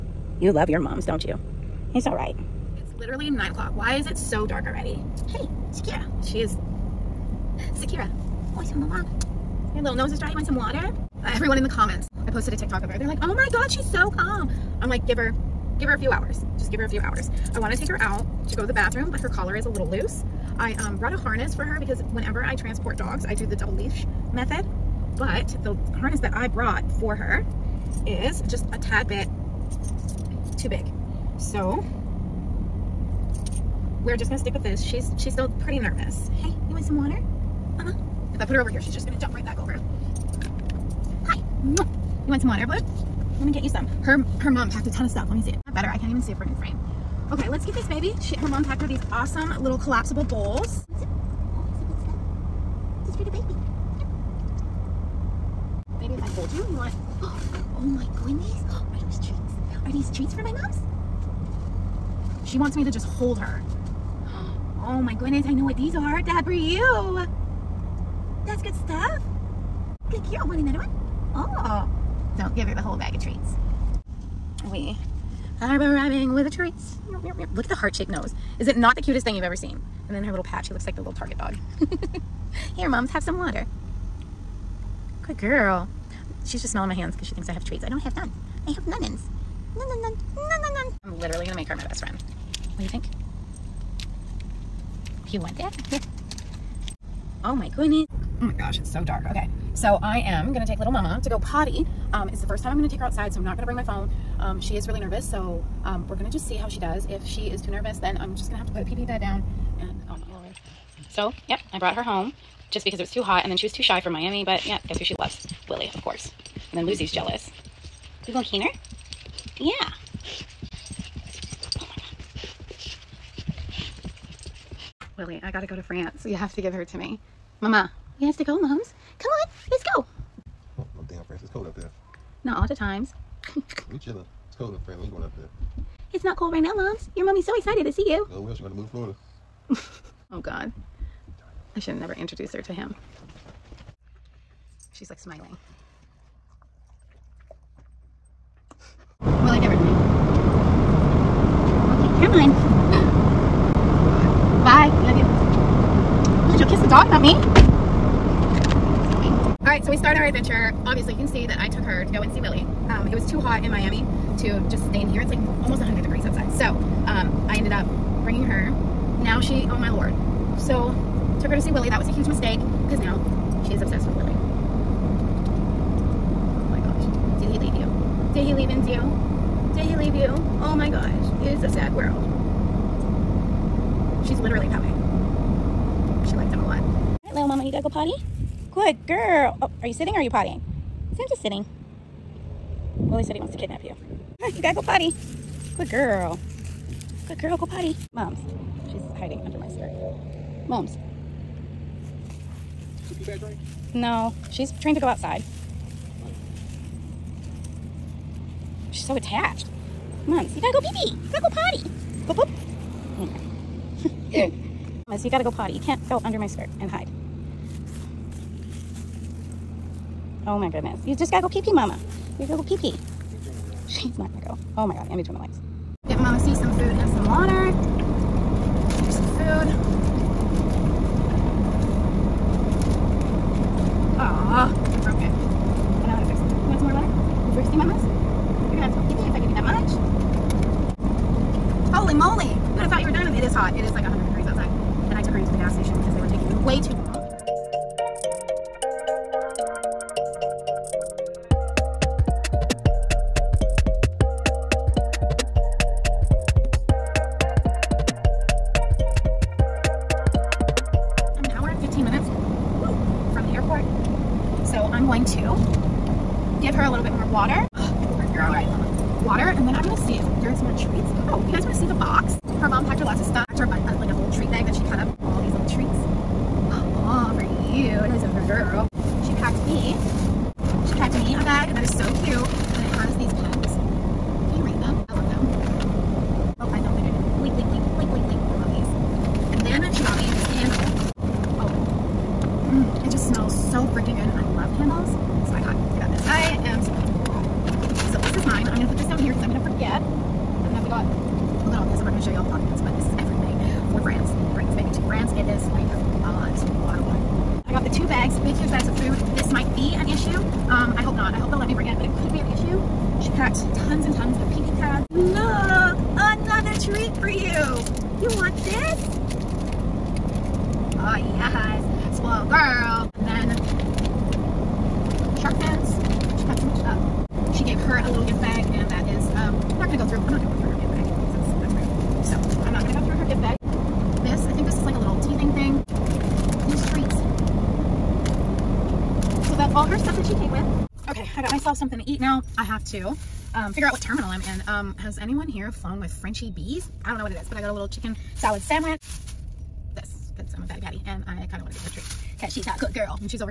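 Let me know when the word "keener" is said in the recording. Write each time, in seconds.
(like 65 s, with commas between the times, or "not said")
118 s.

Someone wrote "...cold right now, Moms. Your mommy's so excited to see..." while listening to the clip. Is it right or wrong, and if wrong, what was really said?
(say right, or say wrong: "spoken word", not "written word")
right.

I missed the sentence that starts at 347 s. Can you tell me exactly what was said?
I don't know what it is, but I got a little chicken salad sandwich.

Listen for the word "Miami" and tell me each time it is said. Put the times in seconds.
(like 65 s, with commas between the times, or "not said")
114 s, 163 s.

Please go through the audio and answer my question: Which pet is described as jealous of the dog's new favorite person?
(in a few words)
Lucy.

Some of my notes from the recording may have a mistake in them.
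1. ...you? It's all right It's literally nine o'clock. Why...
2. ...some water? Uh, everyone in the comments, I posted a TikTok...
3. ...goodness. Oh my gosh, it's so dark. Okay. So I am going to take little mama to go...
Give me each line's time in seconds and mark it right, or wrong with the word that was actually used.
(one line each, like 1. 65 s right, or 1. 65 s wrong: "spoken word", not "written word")
1. 1 s right
2. 10 s right
3. 97 s right.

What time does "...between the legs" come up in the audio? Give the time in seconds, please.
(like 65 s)
225 s.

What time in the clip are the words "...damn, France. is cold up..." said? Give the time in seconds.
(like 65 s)
131 s.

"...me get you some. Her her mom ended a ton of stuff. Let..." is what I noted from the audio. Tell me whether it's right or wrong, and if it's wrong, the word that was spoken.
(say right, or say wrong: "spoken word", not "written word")
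wrong: "packed", not "ended".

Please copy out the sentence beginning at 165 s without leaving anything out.
It's like almost 100 degrees outside.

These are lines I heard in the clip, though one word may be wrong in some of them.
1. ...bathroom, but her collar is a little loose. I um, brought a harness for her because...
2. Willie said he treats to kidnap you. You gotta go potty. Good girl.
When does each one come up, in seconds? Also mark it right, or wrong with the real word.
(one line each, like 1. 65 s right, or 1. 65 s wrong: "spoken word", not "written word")
1. 18 s right
2. 192 s wrong: "wants", not "treats".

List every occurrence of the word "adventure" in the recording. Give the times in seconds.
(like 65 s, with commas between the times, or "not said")
160 s.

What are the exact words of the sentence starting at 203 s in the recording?
No, she's trained to go outside.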